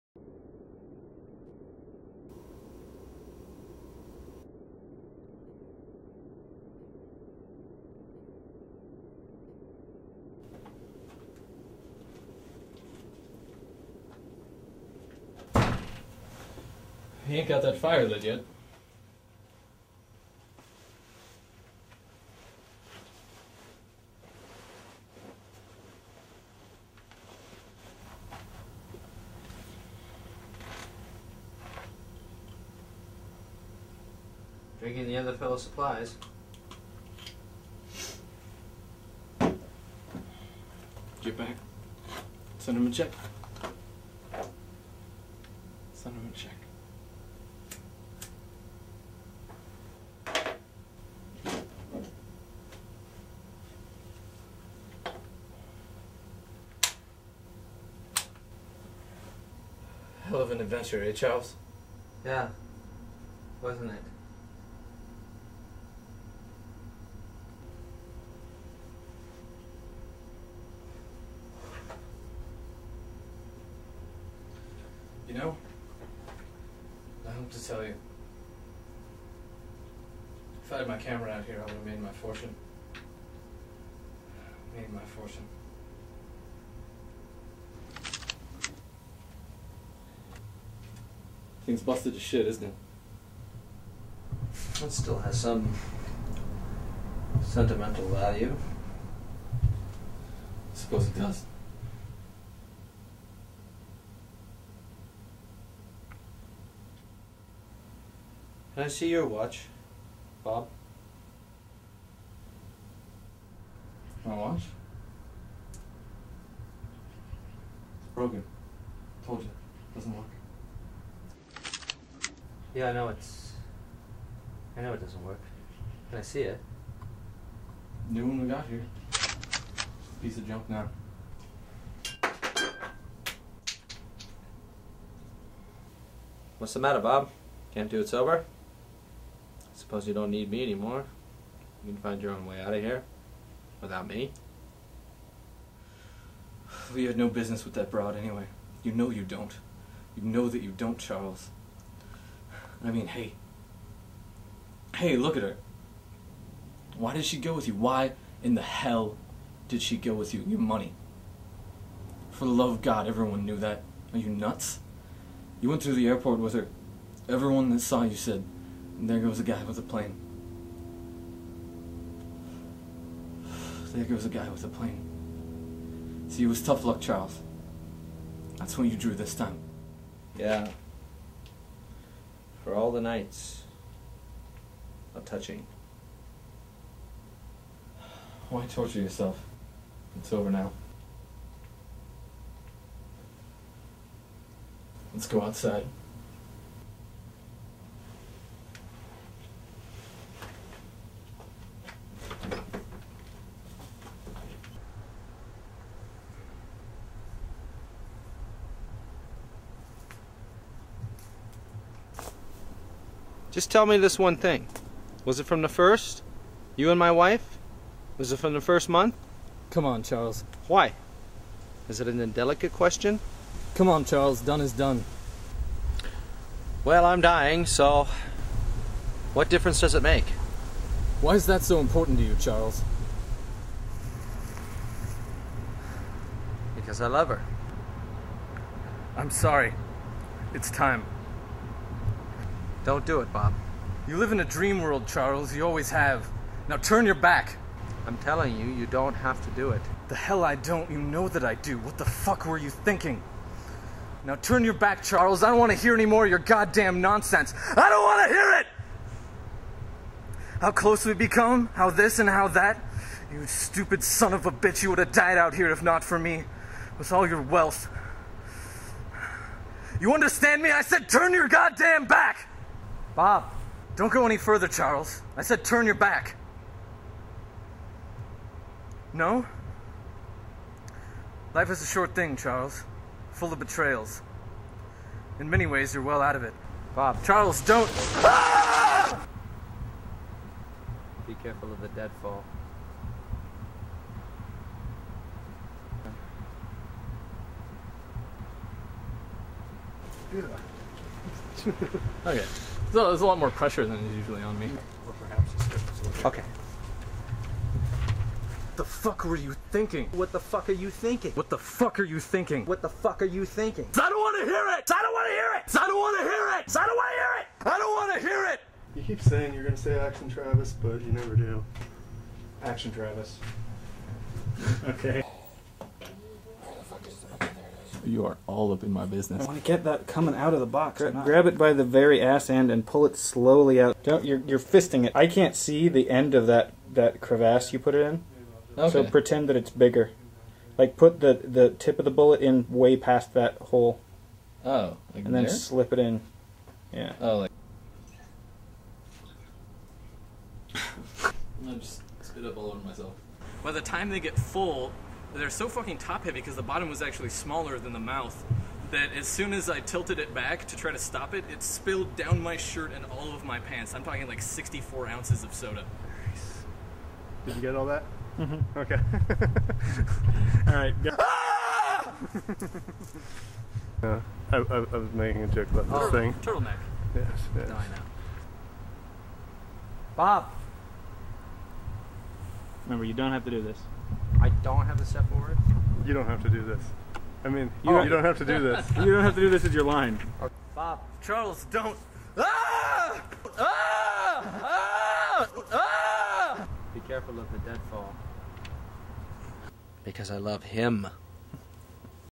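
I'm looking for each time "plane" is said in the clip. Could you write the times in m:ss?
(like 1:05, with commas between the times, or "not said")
2:49, 2:54.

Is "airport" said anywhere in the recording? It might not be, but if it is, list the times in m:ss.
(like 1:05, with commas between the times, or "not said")
2:46.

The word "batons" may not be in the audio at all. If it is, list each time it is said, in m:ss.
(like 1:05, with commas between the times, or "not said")
not said.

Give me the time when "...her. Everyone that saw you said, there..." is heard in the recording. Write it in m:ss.
2:46.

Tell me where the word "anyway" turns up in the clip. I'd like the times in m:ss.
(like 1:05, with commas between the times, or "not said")
2:28.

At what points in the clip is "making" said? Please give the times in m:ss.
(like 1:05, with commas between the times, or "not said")
6:15.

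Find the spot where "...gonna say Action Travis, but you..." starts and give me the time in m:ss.
5:19.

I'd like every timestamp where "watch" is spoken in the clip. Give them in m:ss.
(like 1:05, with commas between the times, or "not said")
1:49, 1:54.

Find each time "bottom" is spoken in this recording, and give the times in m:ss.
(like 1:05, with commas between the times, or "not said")
5:56.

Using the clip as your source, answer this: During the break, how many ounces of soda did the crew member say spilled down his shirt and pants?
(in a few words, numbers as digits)
64.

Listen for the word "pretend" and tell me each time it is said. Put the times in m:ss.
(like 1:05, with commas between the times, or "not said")
5:39.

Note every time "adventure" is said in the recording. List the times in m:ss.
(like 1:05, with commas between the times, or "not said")
1:00.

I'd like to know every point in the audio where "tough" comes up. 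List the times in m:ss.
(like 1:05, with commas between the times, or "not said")
2:56.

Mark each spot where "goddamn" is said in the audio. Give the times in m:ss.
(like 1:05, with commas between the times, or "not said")
4:16, 4:31.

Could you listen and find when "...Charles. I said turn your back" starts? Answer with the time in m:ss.
4:34.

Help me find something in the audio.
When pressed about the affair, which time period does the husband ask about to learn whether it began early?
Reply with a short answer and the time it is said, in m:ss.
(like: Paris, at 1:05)
the first month, at 3:38.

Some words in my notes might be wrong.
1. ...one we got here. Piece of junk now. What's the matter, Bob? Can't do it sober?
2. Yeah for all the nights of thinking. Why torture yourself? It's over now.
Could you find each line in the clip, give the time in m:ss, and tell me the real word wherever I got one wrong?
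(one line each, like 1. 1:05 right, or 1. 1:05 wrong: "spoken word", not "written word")
1. 2:08 right
2. 3:00 wrong: "touching", not "thinking".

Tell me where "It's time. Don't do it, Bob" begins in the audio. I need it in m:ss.
4:00.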